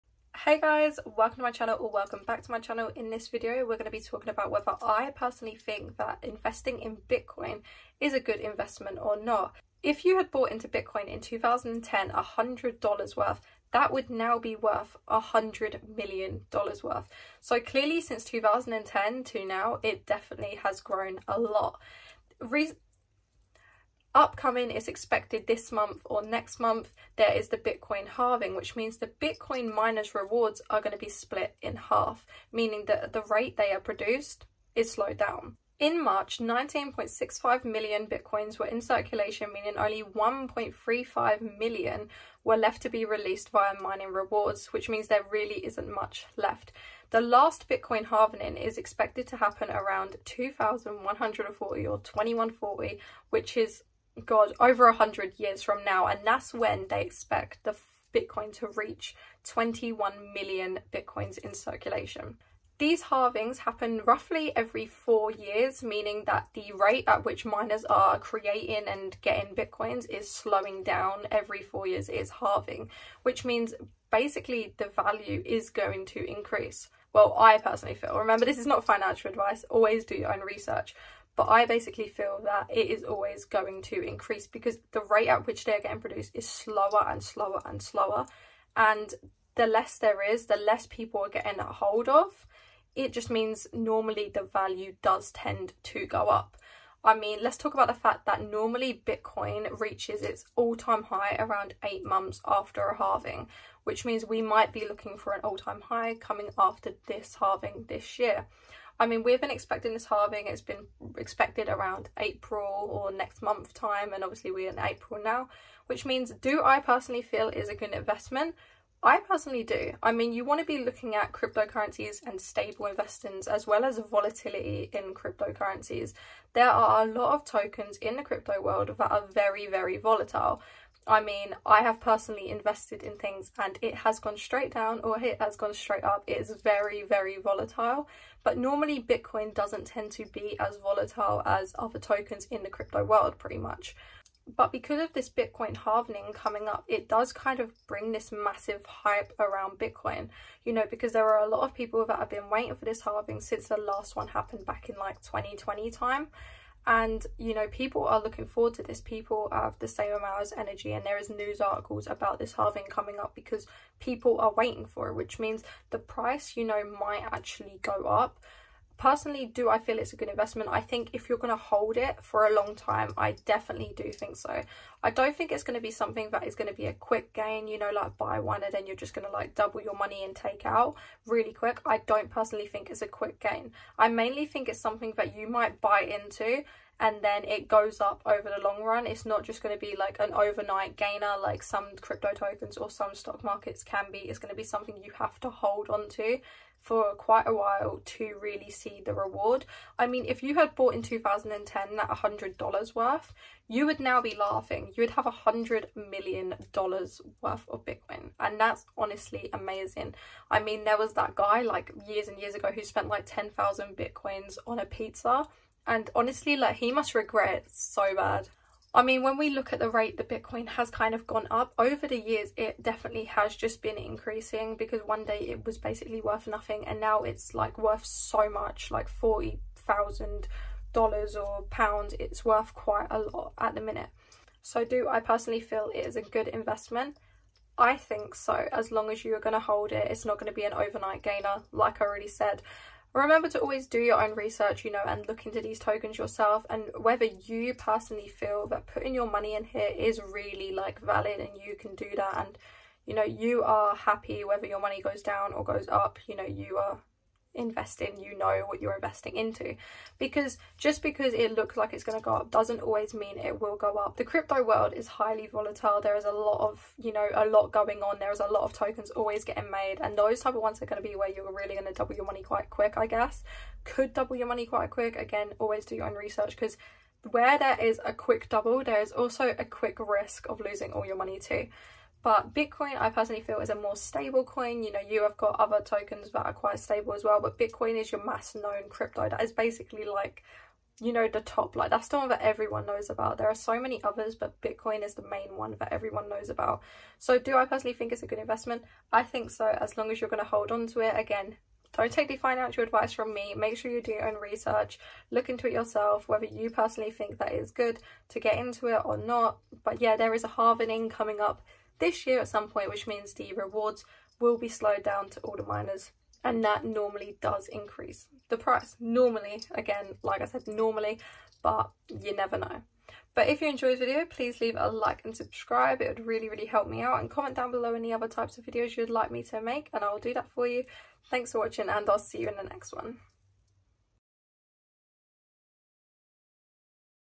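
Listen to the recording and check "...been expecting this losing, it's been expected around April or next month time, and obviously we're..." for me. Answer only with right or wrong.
wrong.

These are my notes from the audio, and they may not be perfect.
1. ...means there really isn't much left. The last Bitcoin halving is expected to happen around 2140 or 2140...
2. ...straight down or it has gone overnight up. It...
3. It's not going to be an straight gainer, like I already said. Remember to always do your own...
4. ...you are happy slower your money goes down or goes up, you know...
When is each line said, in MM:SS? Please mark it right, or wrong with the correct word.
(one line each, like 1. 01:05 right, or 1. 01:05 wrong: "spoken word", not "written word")
1. 00:44 right
2. 02:14 wrong: "straight", not "overnight"
3. 04:00 wrong: "overnight", not "straight"
4. 04:13 wrong: "whether", not "slower".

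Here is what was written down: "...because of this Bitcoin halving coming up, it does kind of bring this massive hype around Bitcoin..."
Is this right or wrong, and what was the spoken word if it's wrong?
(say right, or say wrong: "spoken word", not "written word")
right.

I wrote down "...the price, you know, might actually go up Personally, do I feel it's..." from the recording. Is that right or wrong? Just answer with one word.
right.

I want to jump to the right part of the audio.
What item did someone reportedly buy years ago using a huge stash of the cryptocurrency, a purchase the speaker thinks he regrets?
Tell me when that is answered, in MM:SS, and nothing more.
03:34.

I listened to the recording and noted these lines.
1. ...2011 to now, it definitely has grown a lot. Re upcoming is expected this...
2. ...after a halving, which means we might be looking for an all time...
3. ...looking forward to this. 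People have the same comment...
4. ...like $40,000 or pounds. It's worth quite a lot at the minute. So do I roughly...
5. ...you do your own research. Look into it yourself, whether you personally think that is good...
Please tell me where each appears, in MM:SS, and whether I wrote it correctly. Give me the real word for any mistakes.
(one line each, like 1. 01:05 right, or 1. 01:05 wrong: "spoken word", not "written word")
1. 00:18 wrong: "2010", not "2011"
2. 01:42 right
3. 02:38 wrong: "amount", not "comment"
4. 03:48 wrong: "personally", not "roughly"
5. 05:03 right.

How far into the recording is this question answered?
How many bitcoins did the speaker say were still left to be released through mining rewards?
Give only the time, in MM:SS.
00:40.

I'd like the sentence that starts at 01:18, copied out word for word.
Remember, this is not financial advice.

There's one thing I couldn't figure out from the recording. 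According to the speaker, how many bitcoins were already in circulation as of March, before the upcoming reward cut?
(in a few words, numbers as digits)
19.65 million.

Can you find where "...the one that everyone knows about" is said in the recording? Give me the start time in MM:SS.
04:52.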